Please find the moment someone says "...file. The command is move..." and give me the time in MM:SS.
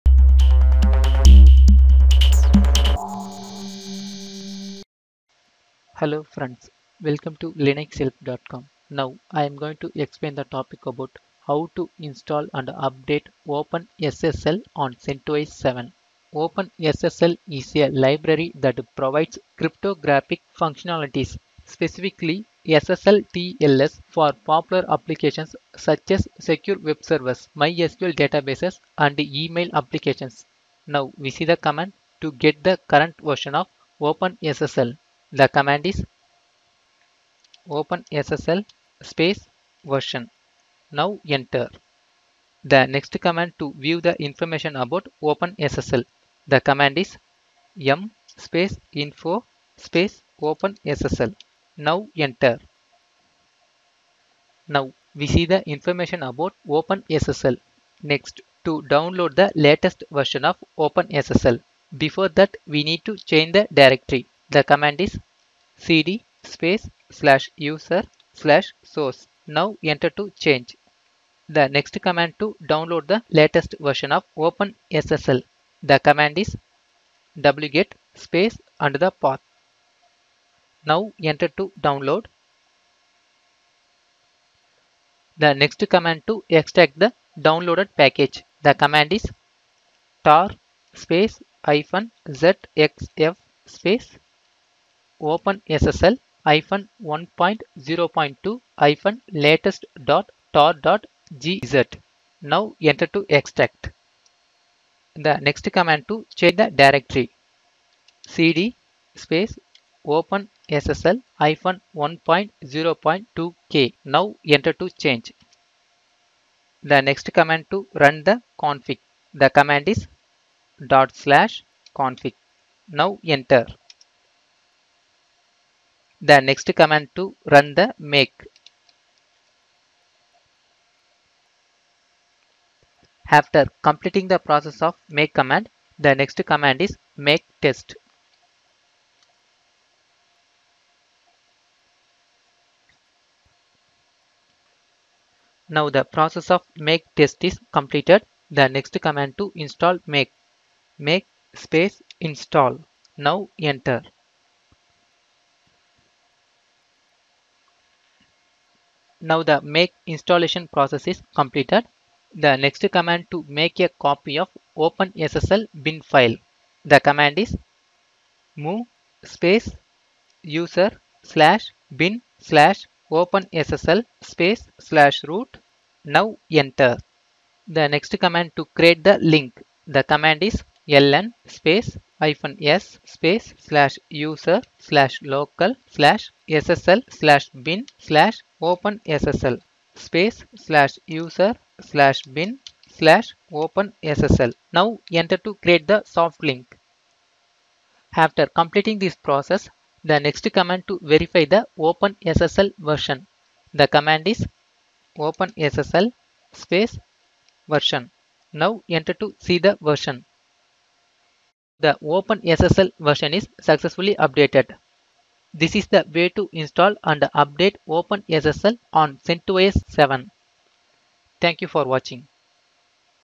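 02:46.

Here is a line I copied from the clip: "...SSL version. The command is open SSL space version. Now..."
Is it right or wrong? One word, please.
right.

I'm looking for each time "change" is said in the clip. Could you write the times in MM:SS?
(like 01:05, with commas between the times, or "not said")
01:03, 01:10, 01:46, 01:55.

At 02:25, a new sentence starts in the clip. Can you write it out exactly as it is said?
Now the process of make test is completed.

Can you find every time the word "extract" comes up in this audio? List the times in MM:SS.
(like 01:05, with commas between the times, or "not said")
01:26, 01:43.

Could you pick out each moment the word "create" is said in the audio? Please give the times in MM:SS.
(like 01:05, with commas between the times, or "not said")
02:58, 03:15.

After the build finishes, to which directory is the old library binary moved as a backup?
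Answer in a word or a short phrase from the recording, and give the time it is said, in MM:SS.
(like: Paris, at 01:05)
/root, at 02:54.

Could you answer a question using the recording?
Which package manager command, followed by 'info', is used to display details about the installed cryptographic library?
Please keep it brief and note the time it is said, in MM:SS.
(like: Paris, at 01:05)
yum, at 00:47.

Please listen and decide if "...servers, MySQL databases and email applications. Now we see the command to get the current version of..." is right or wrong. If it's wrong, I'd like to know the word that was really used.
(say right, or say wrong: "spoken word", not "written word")
right.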